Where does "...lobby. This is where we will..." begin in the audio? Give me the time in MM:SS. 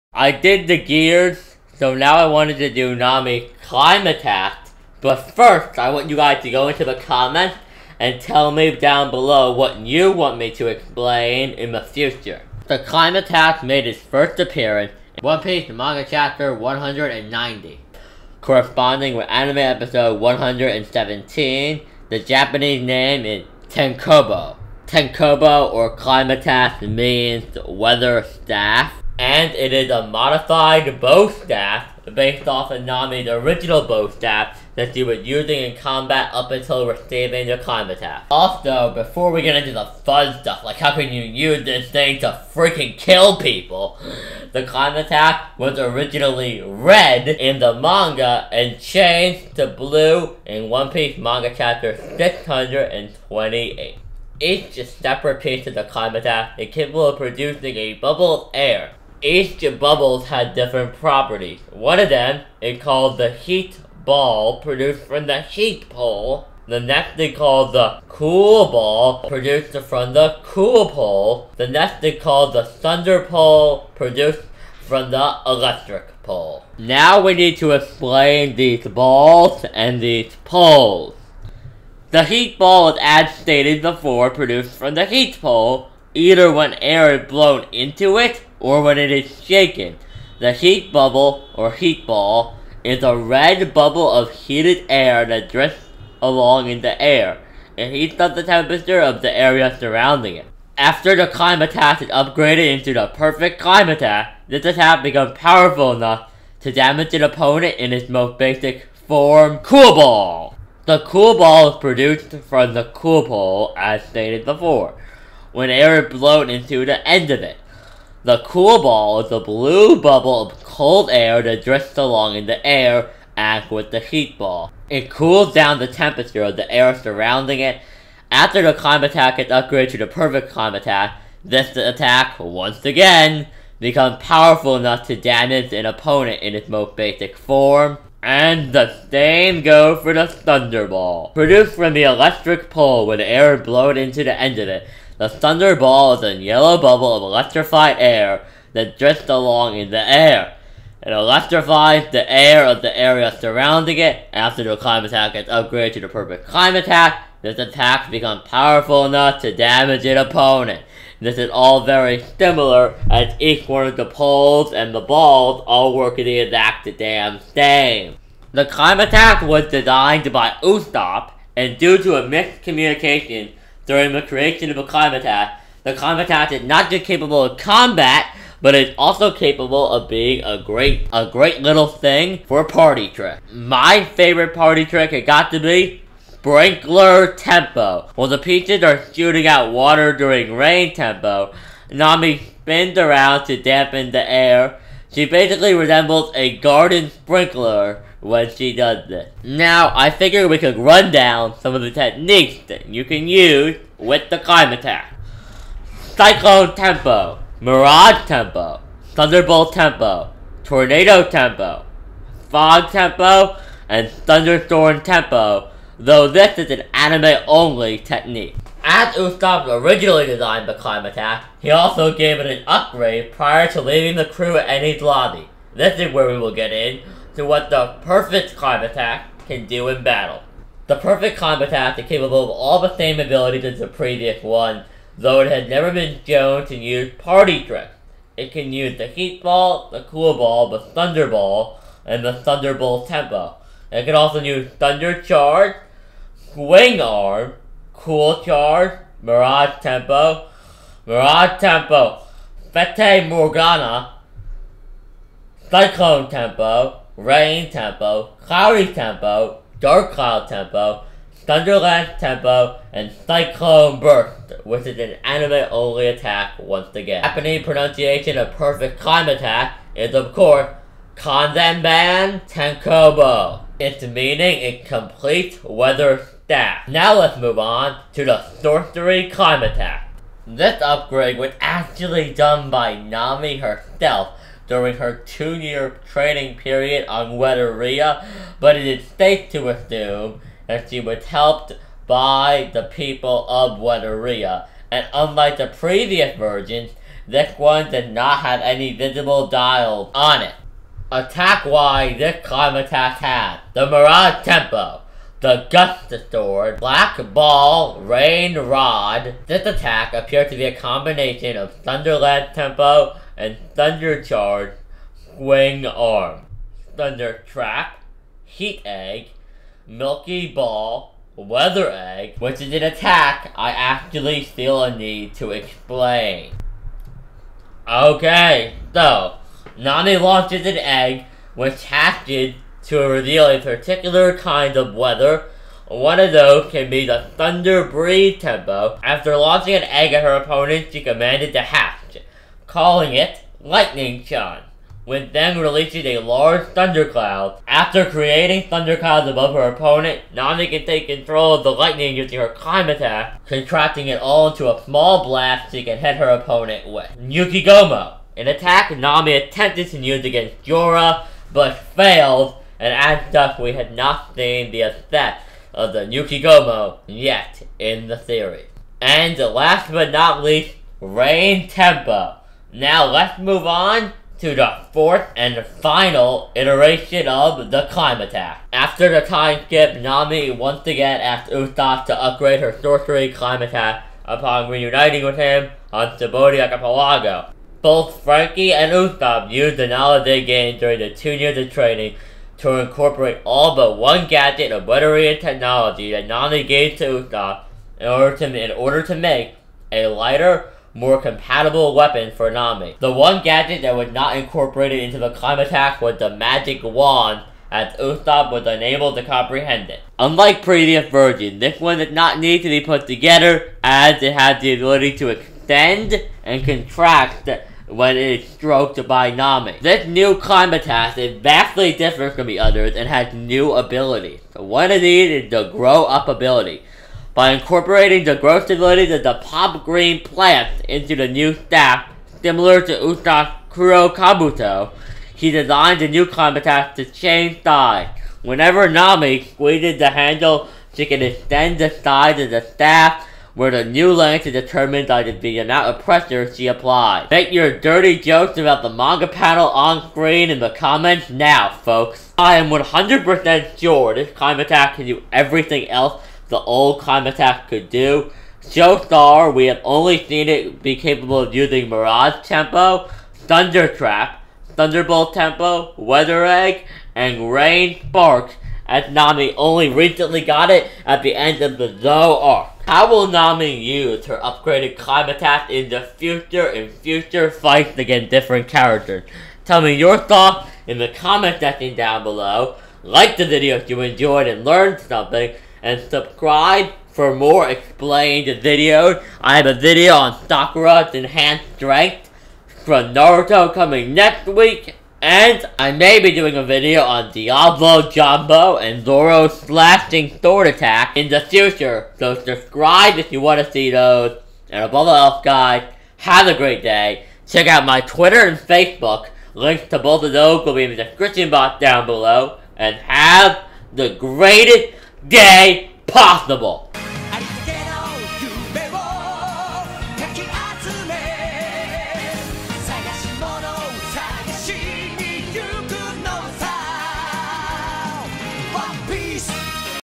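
03:45.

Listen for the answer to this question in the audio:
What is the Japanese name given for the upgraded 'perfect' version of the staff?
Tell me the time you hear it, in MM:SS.
04:31.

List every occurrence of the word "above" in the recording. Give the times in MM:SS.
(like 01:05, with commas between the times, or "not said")
05:49, 08:24.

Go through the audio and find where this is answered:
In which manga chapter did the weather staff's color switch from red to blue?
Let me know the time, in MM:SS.
00:51.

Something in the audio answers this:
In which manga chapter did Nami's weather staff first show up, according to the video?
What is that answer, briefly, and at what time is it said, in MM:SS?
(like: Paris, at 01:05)
190, at 00:16.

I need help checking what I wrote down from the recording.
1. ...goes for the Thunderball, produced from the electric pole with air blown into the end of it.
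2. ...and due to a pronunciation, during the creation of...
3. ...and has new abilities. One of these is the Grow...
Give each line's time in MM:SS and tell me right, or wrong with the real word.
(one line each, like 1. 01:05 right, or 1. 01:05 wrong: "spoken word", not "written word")
1. 02:19 right
2. 02:51 wrong: "miscommunication", not "pronunciation"
3. 07:02 right.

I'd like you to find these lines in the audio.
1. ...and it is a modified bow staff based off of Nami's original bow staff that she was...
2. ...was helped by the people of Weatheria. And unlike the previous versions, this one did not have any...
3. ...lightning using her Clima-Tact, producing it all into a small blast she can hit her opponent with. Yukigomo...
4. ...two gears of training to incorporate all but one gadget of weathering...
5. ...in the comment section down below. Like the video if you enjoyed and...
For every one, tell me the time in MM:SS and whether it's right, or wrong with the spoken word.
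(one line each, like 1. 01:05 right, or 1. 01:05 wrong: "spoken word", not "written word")
1. 00:29 right
2. 04:51 right
3. 05:51 wrong: "contracting", not "producing"
4. 06:31 wrong: "years", not "gears"
5. 08:00 right.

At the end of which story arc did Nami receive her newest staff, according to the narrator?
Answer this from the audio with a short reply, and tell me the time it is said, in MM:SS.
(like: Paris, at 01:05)
Zou arc, at 07:51.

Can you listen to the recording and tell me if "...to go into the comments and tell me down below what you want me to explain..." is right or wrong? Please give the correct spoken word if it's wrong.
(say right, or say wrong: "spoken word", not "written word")
right.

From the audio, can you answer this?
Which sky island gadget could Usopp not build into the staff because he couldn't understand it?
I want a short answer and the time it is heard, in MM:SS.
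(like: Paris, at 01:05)
The magic wand, at 06:46.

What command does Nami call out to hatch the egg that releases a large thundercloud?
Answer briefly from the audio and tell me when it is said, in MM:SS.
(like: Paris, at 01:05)
Lightning John, at 05:43.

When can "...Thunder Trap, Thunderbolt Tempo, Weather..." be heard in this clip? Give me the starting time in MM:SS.
07:43.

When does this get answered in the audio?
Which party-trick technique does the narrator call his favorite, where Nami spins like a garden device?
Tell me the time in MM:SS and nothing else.
03:06.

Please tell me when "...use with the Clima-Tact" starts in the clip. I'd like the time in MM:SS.
03:23.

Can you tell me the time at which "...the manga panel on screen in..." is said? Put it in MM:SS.
07:28.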